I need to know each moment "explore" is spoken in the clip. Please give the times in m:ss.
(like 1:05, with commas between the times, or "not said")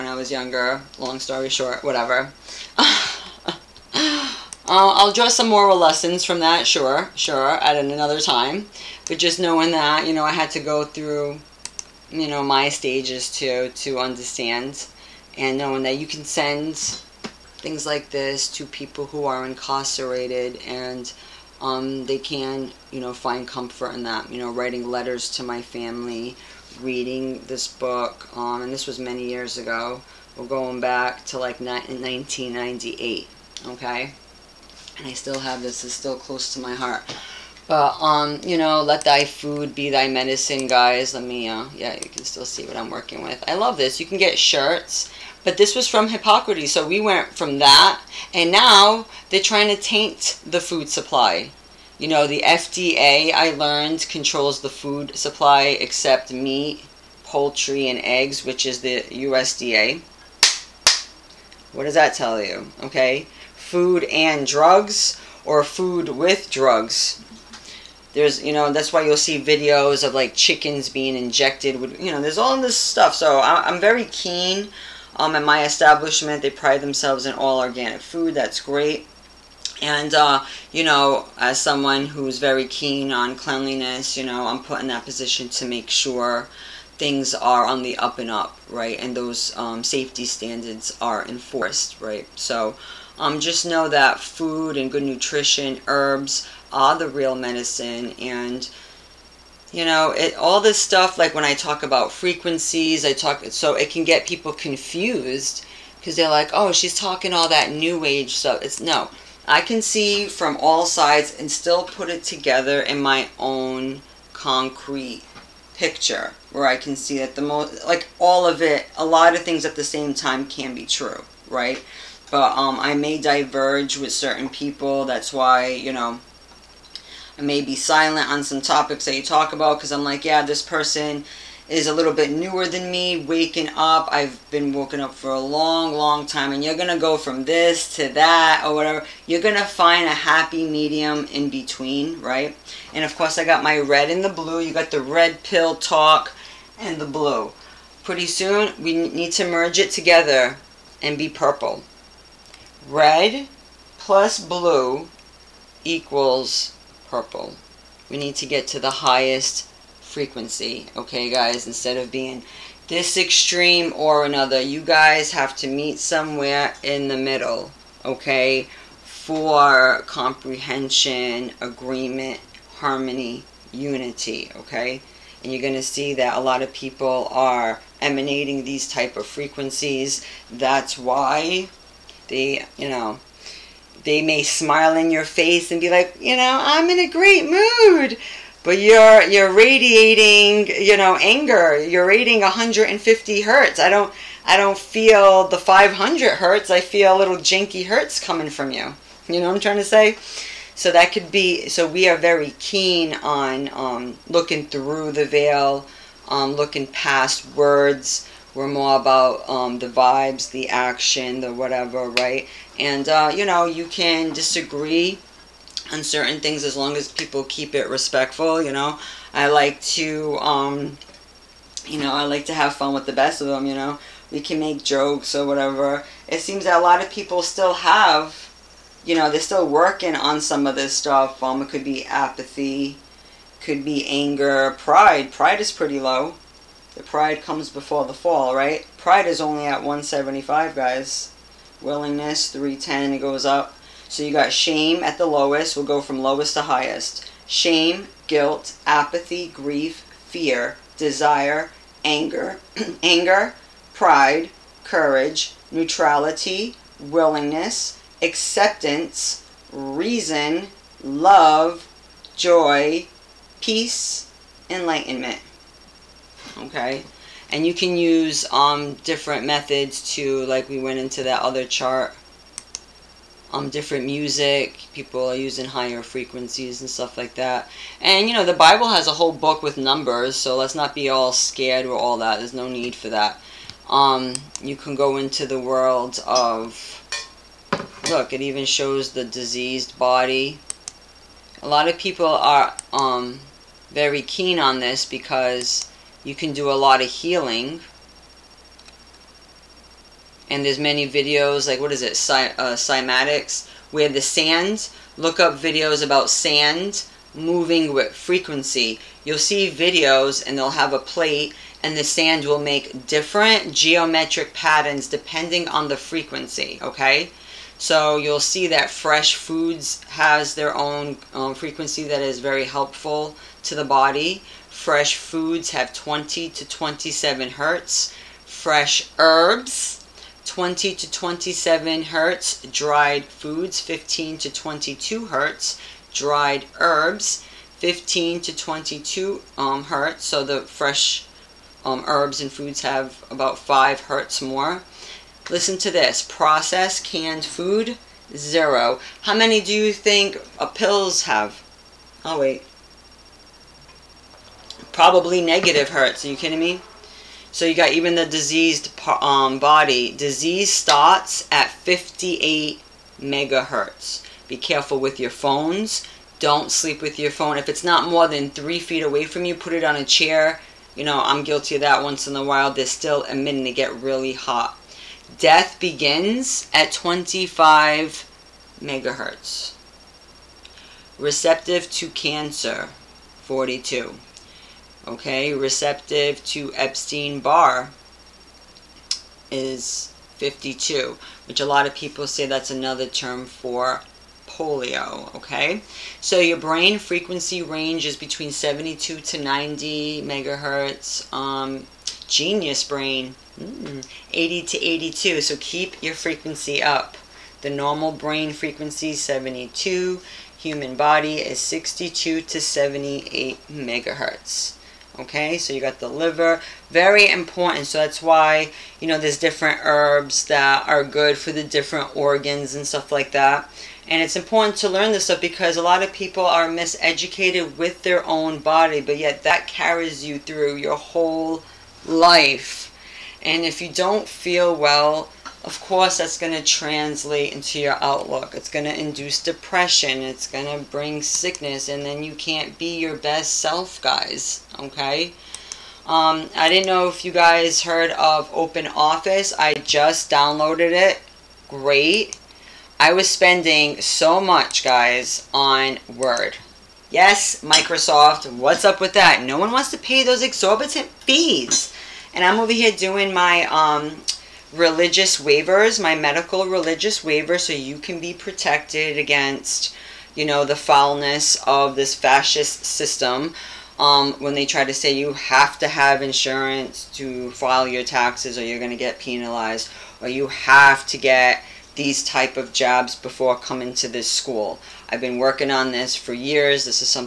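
not said.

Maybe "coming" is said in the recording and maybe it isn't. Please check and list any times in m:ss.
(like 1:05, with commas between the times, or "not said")
3:18, 8:03.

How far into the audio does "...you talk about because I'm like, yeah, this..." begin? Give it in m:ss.
2:09.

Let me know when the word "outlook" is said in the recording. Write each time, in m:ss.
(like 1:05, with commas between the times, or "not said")
7:18.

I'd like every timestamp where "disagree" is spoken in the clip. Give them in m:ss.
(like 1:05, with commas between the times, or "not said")
3:34.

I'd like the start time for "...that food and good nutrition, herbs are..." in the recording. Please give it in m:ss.
1:33.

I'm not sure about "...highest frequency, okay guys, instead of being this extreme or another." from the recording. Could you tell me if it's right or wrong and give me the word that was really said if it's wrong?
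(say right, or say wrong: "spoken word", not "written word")
right.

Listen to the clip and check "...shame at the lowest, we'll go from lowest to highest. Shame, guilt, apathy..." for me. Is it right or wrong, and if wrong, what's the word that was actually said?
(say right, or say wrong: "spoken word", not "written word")
right.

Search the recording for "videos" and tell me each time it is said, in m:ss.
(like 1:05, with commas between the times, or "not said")
1:09, 5:01, 5:05, 5:09.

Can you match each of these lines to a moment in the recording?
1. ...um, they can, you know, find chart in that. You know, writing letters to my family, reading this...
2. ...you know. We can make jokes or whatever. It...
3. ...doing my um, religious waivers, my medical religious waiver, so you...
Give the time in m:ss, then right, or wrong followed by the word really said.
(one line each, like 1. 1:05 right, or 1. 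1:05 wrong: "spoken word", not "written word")
1. 0:21 wrong: "comfort", not "chart"
2. 3:43 right
3. 7:42 right.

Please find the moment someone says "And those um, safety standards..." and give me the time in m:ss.
1:28.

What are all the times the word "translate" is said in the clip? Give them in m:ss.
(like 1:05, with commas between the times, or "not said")
7:16.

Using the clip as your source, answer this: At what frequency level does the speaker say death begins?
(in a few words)
25 megahertz.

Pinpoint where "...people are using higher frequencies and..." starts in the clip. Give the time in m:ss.
4:34.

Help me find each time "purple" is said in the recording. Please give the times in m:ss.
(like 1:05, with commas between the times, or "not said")
2:31, 2:37.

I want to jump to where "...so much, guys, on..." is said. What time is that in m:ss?
7:33.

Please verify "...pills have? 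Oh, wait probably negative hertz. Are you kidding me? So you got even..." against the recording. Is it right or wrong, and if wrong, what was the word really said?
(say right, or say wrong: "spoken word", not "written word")
right.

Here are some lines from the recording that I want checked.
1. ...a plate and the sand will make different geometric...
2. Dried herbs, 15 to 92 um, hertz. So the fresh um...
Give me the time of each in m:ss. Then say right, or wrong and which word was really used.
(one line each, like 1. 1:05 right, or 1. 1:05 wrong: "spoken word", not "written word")
1. 5:10 right
2. 5:36 wrong: "22", not "92".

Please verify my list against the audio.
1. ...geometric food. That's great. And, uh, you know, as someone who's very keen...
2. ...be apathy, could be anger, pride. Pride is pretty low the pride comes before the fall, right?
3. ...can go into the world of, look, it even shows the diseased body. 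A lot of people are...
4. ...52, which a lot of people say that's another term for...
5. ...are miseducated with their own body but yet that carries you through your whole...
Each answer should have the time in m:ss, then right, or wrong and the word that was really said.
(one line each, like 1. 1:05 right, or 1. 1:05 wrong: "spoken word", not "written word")
1. 1:17 wrong: "organic", not "geometric"
2. 3:51 right
3. 4:44 right
4. 6:30 right
5. 7:06 right.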